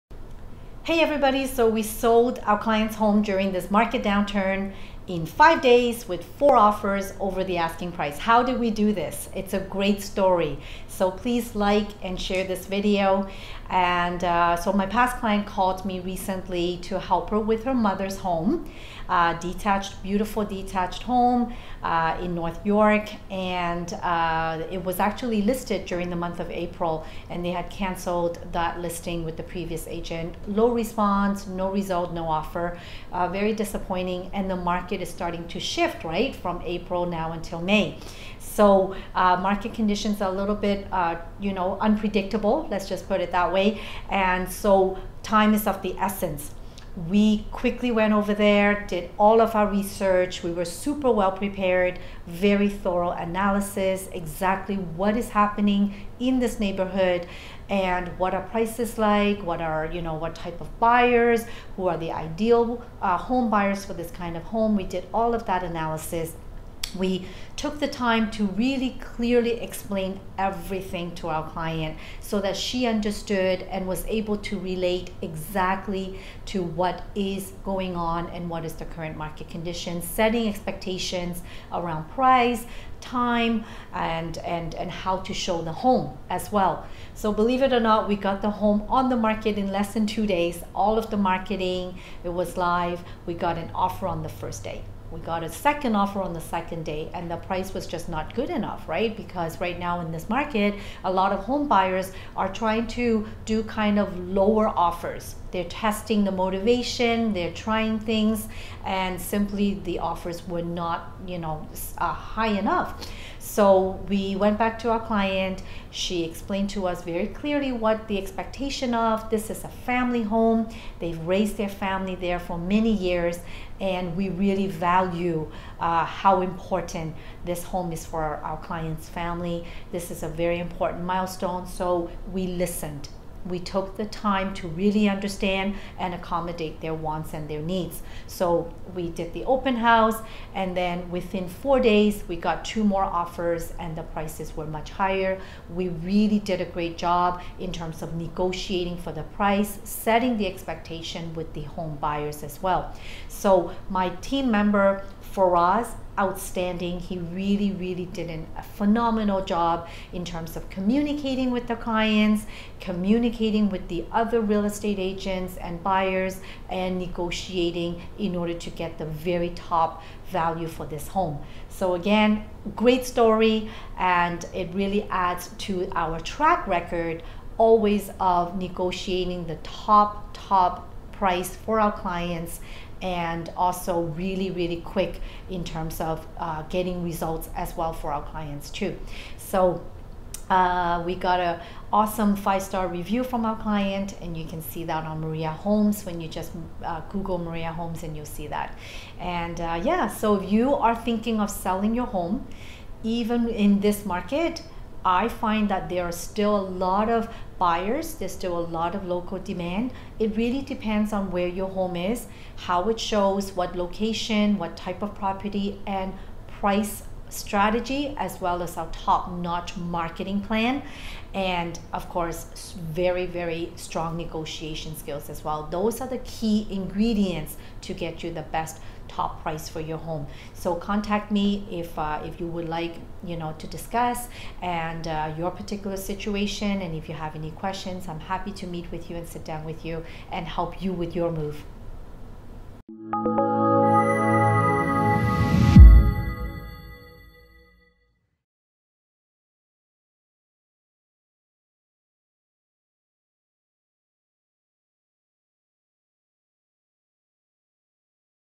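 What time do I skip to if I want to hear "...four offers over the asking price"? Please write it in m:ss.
0:06.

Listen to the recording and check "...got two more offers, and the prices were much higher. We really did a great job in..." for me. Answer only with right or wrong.
right.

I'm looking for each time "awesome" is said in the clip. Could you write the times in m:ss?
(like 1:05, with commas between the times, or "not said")
3:11.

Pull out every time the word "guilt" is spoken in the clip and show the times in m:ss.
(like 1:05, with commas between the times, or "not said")
not said.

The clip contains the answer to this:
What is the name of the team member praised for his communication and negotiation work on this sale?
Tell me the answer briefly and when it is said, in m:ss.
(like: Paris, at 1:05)
Faraz, at 2:35.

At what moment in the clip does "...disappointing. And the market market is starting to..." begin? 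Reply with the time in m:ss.
0:33.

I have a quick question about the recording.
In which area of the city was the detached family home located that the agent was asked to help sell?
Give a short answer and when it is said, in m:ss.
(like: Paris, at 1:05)
North York, at 0:22.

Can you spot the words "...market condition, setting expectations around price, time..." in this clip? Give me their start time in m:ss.
1:19.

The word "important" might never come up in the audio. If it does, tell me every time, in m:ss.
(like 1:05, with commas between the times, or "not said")
2:06, 2:10.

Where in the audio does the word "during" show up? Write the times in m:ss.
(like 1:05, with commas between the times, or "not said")
0:03, 0:25.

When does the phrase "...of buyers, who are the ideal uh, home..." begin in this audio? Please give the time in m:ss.
1:00.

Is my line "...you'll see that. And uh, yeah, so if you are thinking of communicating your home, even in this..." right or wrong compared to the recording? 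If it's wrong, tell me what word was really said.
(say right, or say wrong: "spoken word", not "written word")
wrong: "selling", not "communicating".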